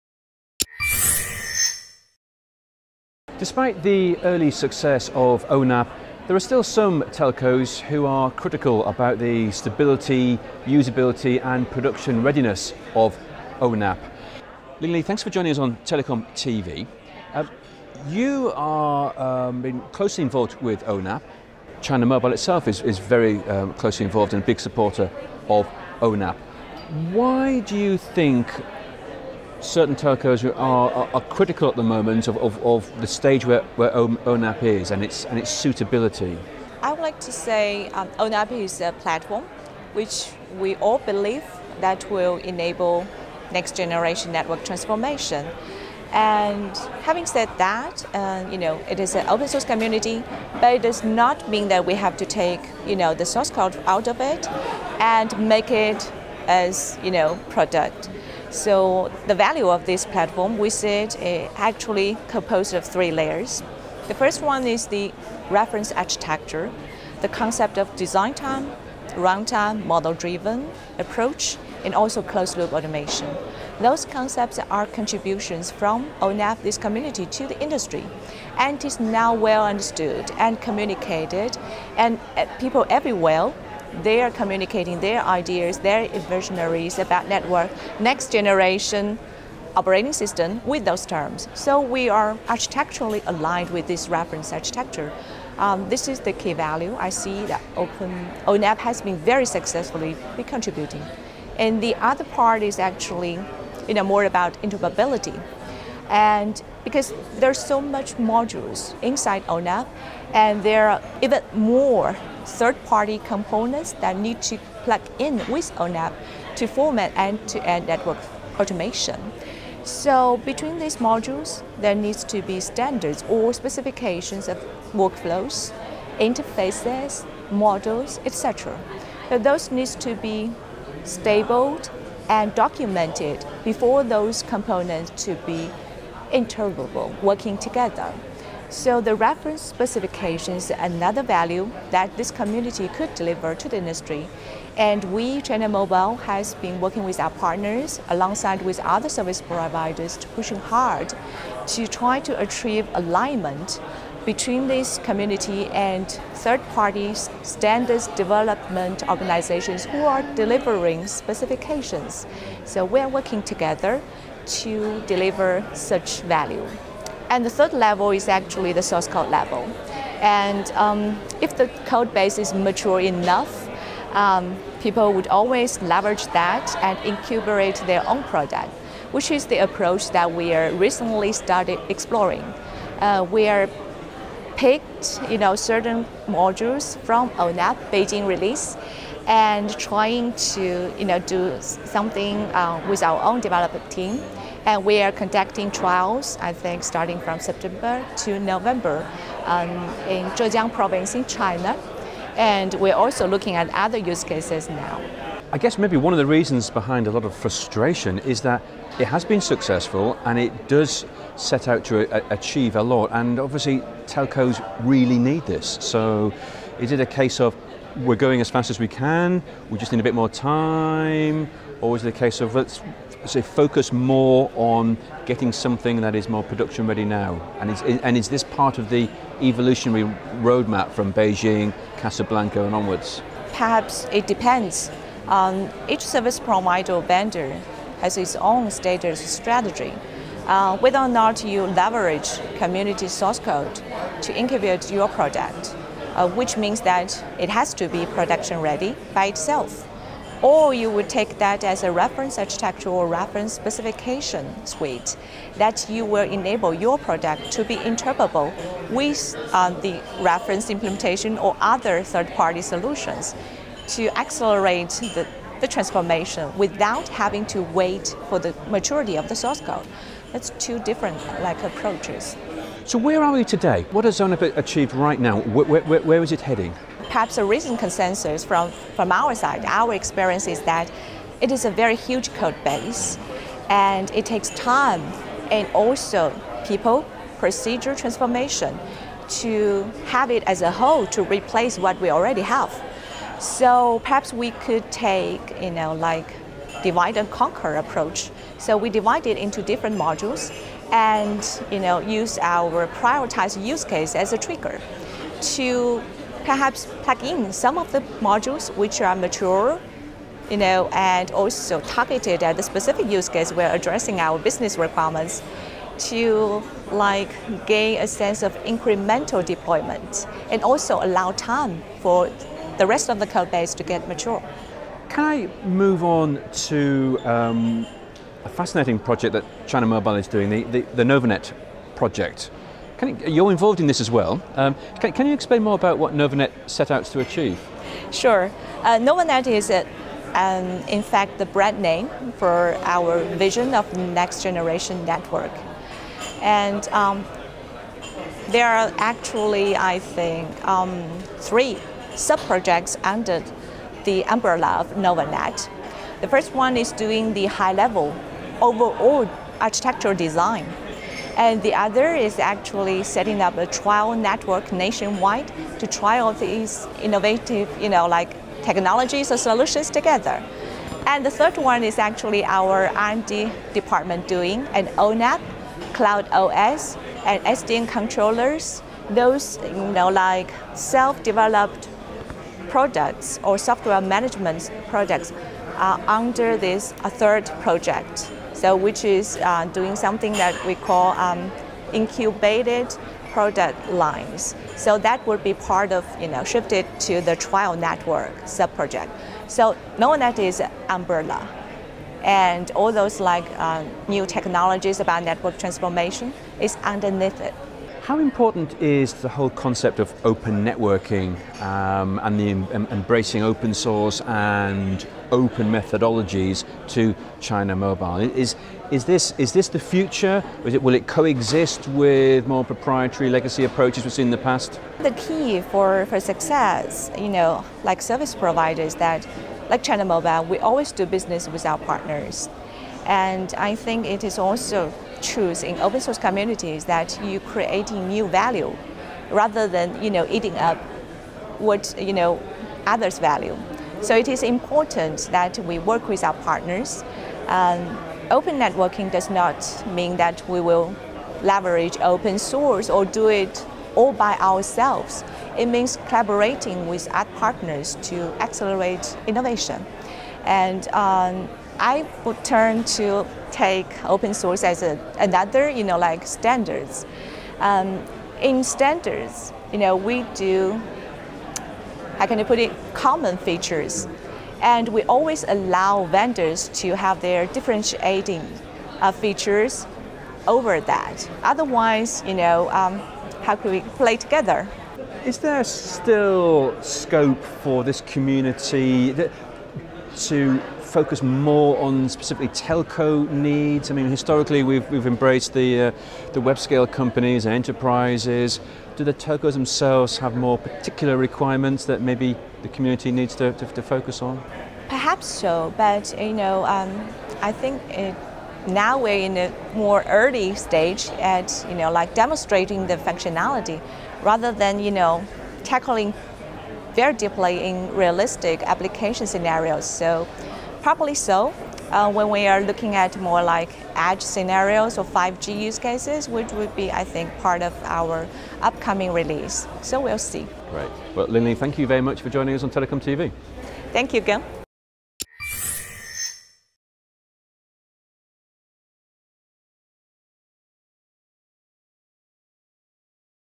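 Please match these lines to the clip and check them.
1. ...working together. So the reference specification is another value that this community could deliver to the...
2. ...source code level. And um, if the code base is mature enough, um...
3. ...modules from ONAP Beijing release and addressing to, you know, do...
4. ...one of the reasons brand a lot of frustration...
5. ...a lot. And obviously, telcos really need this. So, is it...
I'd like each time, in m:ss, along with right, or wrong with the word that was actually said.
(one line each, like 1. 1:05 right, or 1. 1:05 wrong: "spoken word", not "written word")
1. 2:17 right
2. 2:48 right
3. 3:06 wrong: "trying", not "addressing"
4. 3:25 wrong: "behind", not "brand"
5. 3:32 right.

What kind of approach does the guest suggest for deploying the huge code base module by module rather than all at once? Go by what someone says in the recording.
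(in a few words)
divide and conquer.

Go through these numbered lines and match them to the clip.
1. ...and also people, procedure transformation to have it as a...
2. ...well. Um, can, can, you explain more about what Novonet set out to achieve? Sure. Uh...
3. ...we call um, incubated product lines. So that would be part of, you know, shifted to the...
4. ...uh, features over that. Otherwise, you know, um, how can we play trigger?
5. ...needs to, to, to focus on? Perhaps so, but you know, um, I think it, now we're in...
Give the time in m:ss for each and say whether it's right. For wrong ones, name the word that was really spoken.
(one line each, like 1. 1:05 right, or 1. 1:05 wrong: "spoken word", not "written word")
1. 4:45 right
2. 5:34 right
3. 6:30 right
4. 7:58 wrong: "together", not "trigger"
5. 8:23 right.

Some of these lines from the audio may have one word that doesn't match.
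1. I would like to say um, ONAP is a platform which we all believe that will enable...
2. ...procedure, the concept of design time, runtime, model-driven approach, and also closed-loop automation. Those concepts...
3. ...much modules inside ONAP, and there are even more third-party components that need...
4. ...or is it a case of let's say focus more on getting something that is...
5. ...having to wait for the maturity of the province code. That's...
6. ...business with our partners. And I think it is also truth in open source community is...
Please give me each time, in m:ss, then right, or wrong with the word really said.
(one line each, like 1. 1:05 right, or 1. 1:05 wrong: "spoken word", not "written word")
1. 0:36 right
2. 1:05 wrong: "architecture", not "procedure"
3. 1:47 right
4. 3:41 right
5. 4:27 wrong: "source", not "province"
6. 7:11 right.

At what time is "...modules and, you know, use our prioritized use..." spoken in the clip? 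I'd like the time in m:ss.
4:59.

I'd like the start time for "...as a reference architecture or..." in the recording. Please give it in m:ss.
4:11.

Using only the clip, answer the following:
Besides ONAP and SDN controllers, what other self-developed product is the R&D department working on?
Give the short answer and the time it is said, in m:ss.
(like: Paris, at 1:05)
Cloud OS, at 6:15.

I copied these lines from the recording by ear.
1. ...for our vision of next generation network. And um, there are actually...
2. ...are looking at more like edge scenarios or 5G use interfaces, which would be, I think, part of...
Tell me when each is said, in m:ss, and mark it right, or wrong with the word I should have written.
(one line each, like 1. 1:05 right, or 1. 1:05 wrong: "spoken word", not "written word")
1. 5:42 right
2. 8:42 wrong: "cases", not "interfaces".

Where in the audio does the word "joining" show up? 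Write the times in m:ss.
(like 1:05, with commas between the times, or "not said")
0:15, 8:52.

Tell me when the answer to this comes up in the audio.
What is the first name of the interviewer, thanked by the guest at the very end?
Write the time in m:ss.
8:54.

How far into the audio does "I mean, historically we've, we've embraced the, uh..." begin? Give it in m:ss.
8:13.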